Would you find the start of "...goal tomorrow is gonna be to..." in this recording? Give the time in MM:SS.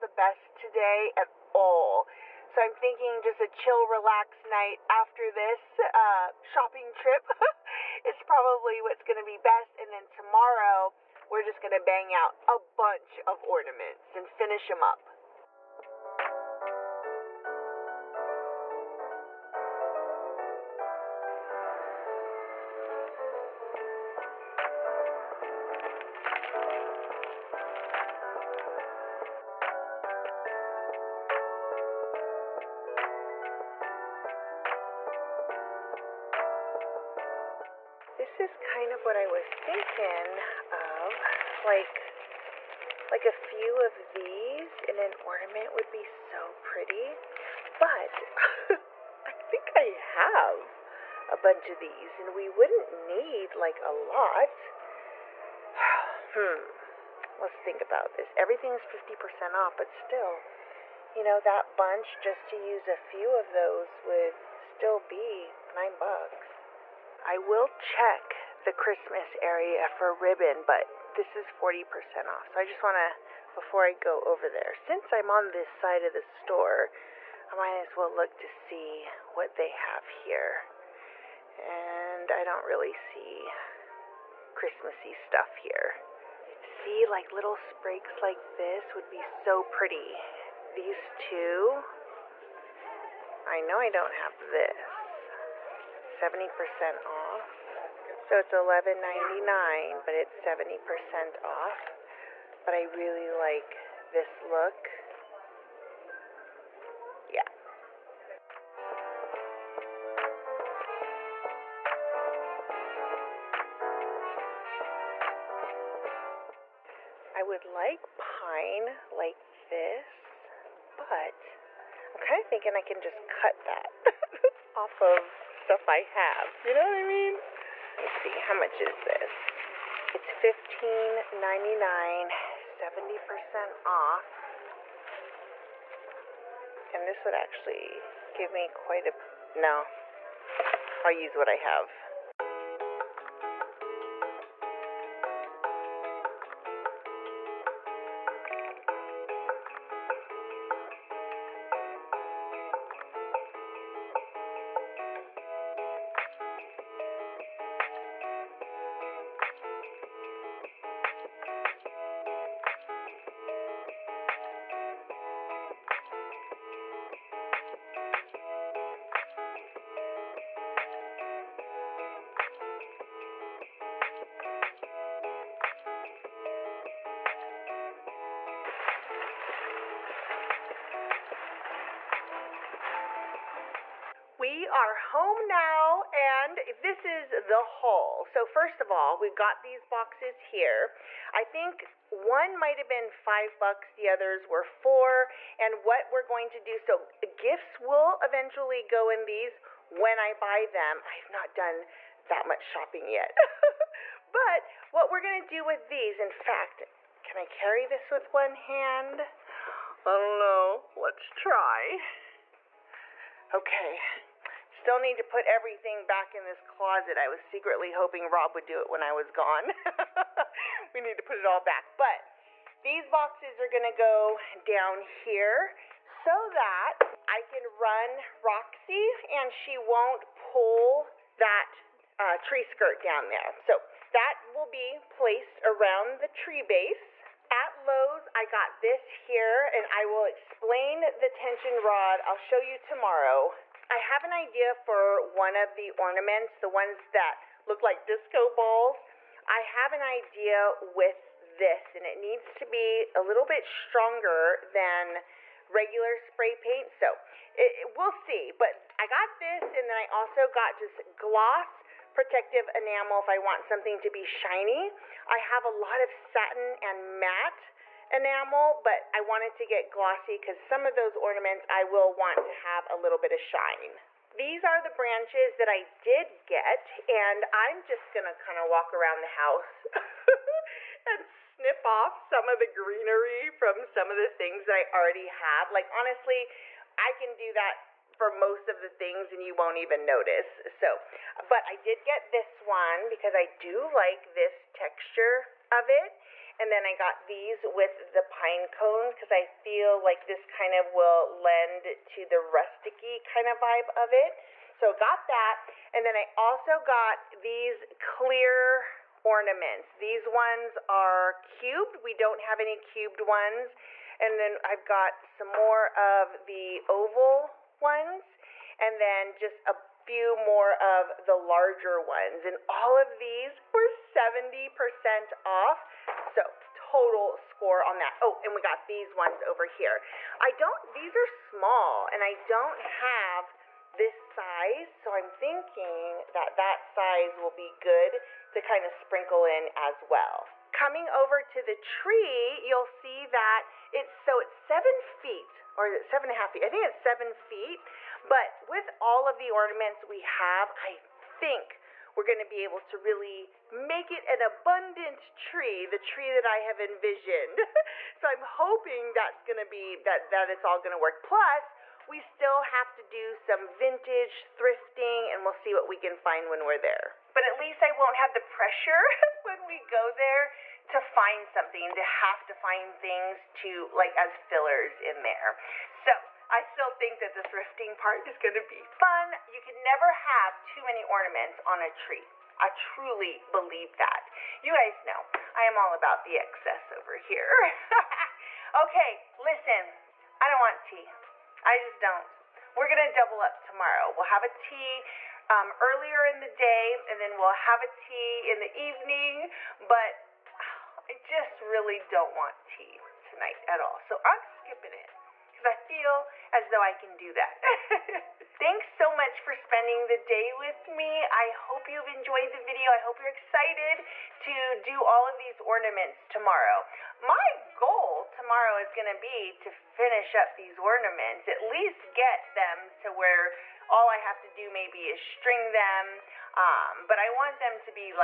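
06:57.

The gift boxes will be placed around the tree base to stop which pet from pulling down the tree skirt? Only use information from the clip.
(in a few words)
Roxy.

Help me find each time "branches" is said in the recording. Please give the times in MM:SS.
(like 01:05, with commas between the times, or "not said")
04:34.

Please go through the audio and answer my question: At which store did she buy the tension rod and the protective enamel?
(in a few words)
Lowe's.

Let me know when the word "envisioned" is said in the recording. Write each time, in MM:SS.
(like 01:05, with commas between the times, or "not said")
05:56.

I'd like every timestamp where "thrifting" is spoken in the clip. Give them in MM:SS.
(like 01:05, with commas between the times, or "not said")
06:04, 06:17.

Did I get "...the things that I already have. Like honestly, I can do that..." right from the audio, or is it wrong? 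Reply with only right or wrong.
right.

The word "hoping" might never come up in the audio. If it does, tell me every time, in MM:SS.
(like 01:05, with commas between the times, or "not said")
03:37, 05:58.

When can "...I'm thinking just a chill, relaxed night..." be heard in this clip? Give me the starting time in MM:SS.
00:02.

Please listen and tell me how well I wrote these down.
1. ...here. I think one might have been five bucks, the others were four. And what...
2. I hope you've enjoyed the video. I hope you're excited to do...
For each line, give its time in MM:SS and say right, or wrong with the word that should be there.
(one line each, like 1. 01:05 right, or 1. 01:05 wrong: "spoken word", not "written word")
1. 03:10 right
2. 06:51 right.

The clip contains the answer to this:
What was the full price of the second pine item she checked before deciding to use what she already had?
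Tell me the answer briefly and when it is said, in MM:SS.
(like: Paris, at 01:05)
$15.99, at 02:10.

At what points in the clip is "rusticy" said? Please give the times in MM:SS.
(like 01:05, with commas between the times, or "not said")
05:02.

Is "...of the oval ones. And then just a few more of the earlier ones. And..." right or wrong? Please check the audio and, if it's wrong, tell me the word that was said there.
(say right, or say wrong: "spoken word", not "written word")
wrong: "larger", not "earlier".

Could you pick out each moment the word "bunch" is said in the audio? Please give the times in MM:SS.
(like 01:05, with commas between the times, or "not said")
00:12, 00:51, 01:01.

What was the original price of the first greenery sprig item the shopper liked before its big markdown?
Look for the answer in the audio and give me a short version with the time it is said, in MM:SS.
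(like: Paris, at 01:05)
$11.99, at 01:38.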